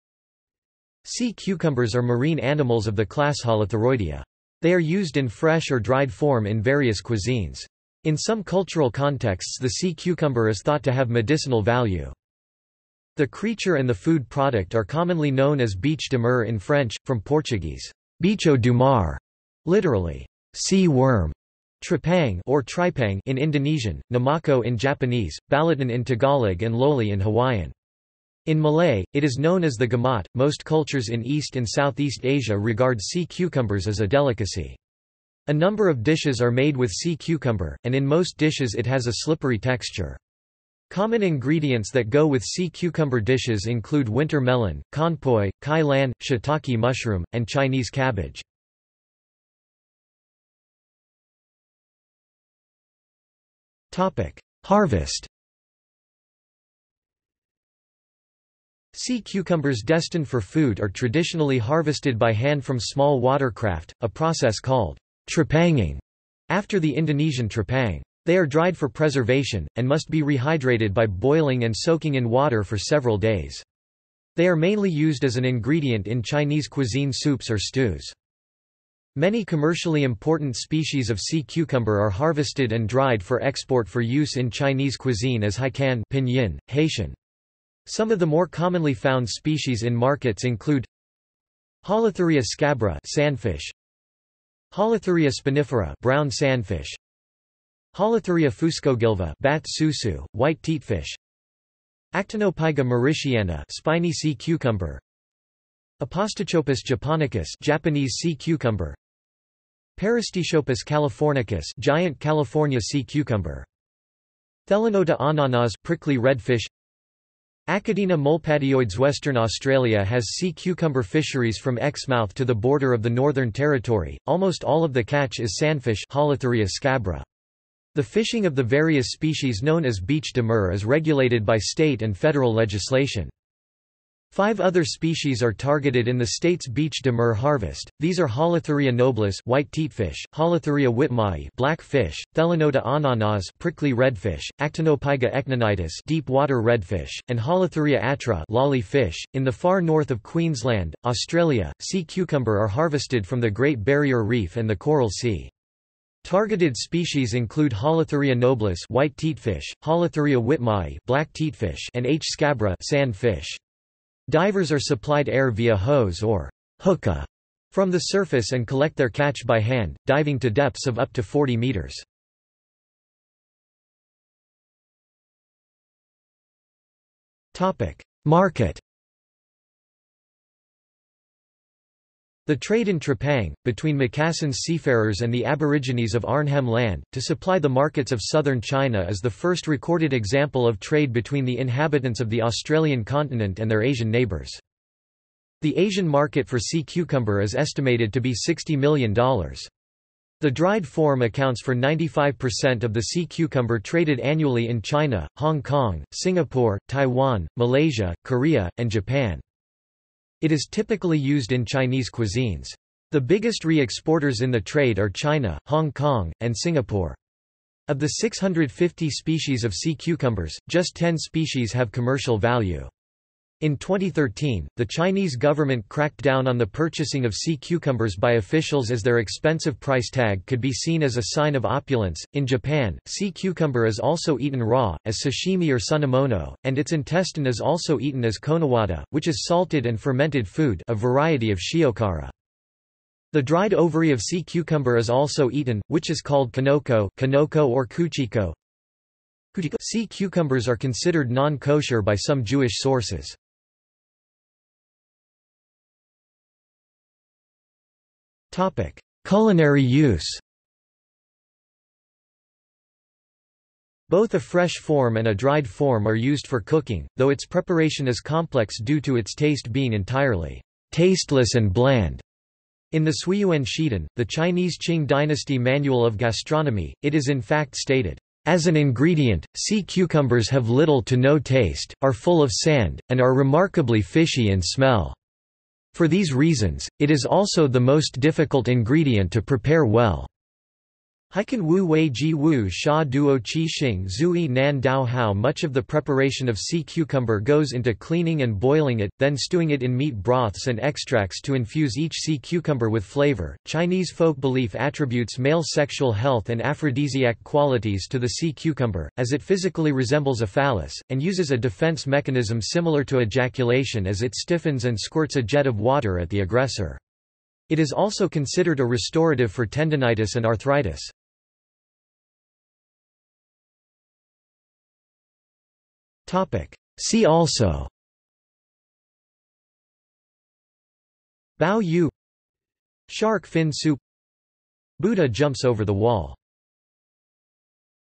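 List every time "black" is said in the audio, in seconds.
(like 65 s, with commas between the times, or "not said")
141 s, 161 s.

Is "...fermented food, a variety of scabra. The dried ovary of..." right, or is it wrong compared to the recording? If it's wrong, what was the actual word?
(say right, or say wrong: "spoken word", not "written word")
wrong: "shiokara", not "scabra".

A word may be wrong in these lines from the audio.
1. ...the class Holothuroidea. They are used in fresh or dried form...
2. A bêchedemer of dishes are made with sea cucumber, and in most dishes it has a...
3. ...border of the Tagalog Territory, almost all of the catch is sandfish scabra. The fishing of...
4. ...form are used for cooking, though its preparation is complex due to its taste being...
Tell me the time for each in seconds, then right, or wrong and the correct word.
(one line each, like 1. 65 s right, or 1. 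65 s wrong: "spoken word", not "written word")
1. 2 s right
2. 35 s wrong: "number", not "bêchedemer"
3. 122 s wrong: "Northern", not "Tagalog"
4. 265 s right.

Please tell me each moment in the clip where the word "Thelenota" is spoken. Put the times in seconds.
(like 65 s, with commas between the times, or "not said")
114 s, 142 s.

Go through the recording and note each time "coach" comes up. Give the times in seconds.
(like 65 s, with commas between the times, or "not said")
not said.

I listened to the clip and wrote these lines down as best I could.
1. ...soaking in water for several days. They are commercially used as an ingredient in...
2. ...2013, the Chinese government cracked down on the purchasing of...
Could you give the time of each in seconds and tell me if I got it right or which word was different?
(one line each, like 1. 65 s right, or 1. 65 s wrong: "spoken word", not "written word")
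1. 71 s wrong: "mainly", not "commercially"
2. 223 s right.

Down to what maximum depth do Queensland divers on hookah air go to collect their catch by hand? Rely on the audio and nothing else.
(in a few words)
40 meters.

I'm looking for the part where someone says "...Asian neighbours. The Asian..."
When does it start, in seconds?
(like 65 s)
193 s.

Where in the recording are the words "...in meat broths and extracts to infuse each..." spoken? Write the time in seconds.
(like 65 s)
299 s.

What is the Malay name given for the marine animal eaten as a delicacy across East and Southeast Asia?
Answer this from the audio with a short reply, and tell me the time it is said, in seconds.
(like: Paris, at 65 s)
gamat, at 29 s.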